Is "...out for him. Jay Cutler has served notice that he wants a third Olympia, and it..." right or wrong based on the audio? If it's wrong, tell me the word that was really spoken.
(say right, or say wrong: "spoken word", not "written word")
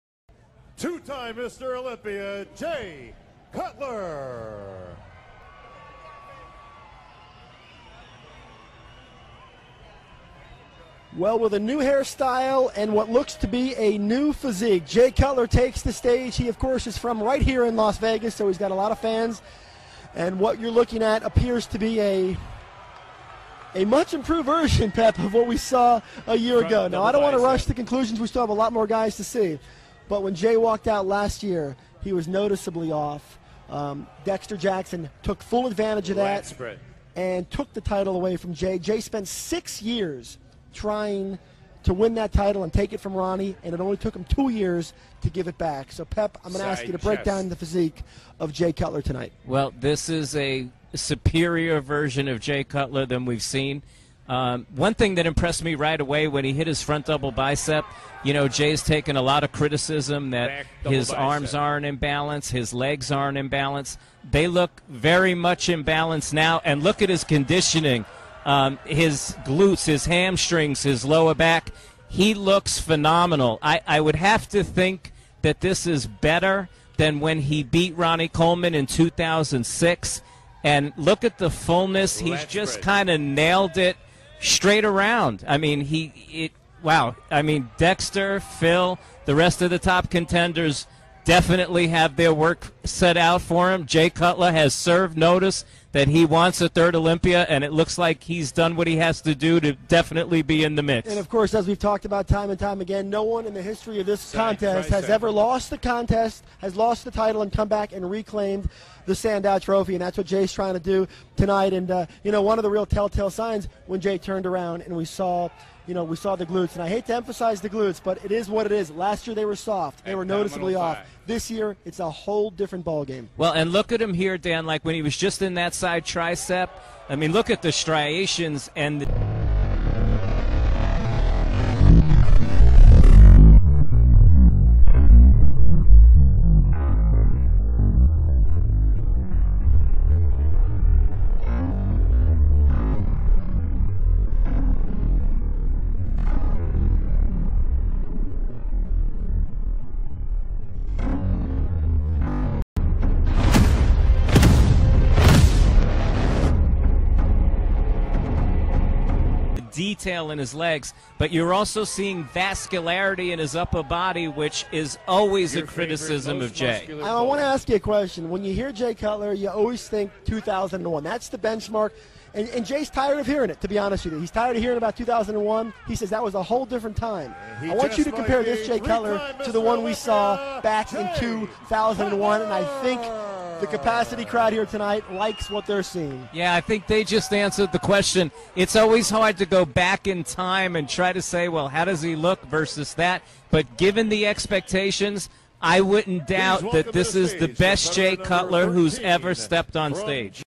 right.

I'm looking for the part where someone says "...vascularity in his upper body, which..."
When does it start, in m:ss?
2:42.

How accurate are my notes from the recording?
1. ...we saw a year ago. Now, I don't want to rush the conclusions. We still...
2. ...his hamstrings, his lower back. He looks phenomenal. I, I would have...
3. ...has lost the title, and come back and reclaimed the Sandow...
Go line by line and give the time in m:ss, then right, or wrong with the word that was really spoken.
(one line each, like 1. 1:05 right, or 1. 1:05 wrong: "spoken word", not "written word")
1. 0:25 right
2. 1:09 right
3. 1:46 right.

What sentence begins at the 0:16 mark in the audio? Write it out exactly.
He, of course, is from right here in Las Vegas, so he's got a lot of fans.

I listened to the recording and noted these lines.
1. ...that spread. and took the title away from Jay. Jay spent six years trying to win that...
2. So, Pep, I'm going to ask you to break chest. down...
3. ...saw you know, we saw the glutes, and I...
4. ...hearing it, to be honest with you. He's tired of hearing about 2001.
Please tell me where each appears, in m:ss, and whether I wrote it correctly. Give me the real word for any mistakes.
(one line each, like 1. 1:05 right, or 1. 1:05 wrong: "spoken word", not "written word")
1. 0:36 right
2. 0:45 right
3. 1:55 right
4. 2:53 right.